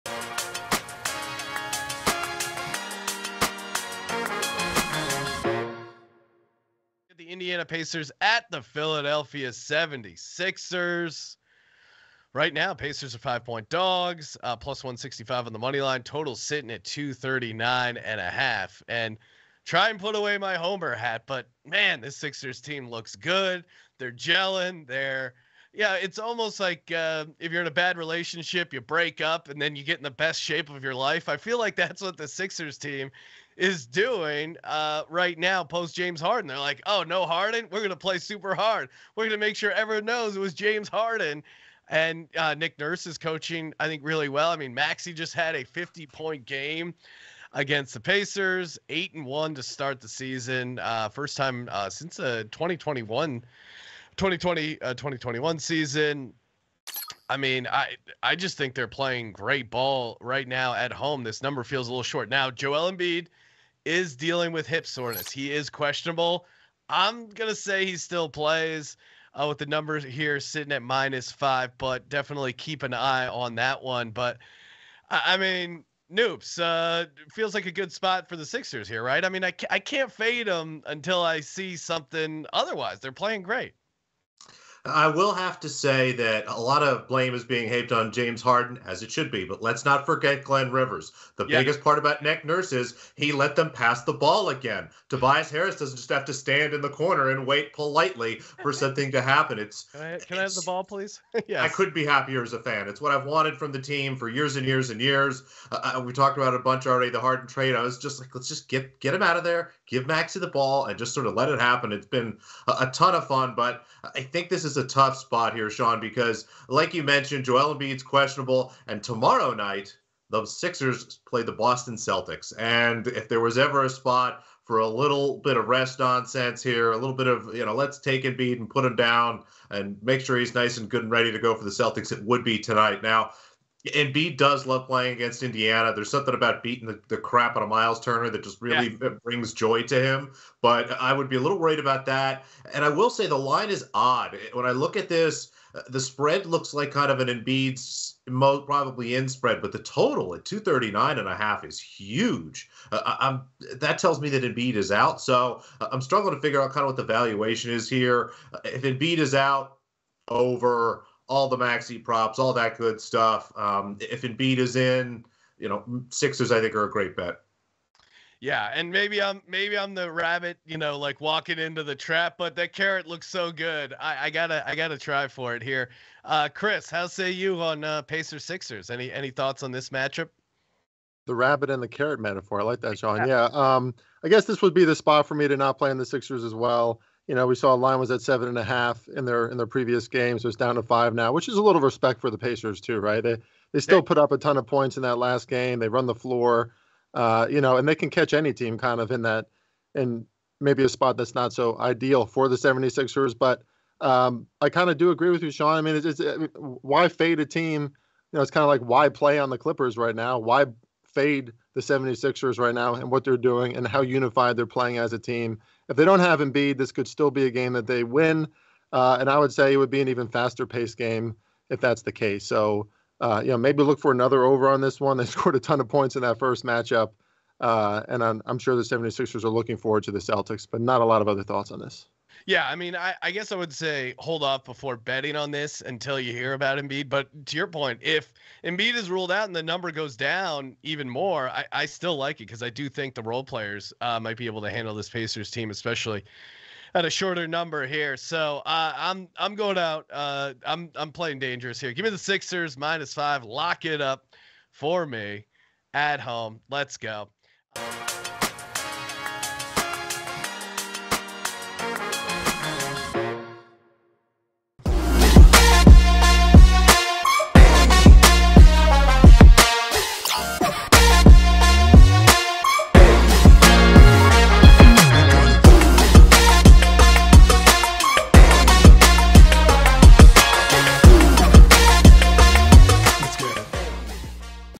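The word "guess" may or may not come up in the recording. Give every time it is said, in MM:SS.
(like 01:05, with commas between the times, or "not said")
03:04, 03:53.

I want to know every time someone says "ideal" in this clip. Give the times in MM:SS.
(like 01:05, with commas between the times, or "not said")
03:21.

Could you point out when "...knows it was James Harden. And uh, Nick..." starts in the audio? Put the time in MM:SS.
00:40.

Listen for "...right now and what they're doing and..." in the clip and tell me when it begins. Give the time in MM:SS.
03:32.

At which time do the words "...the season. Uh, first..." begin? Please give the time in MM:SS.
00:49.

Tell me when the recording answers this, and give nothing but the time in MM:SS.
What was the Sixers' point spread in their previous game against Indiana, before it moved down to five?
03:08.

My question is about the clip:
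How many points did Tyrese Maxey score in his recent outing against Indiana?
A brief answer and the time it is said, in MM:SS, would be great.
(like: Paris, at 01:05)
50, at 00:45.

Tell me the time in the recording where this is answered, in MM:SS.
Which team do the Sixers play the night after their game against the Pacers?
02:01.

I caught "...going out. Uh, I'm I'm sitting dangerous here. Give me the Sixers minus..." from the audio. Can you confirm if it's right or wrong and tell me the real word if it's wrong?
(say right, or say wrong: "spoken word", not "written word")
wrong: "playing", not "sitting".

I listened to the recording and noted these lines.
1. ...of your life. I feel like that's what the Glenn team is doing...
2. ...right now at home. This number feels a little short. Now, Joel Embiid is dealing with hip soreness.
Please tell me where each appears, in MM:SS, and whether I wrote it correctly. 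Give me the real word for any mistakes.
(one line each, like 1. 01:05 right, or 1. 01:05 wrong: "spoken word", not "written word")
1. 00:30 wrong: "Sixers", not "Glenn"
2. 01:00 right.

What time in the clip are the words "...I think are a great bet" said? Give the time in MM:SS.
02:46.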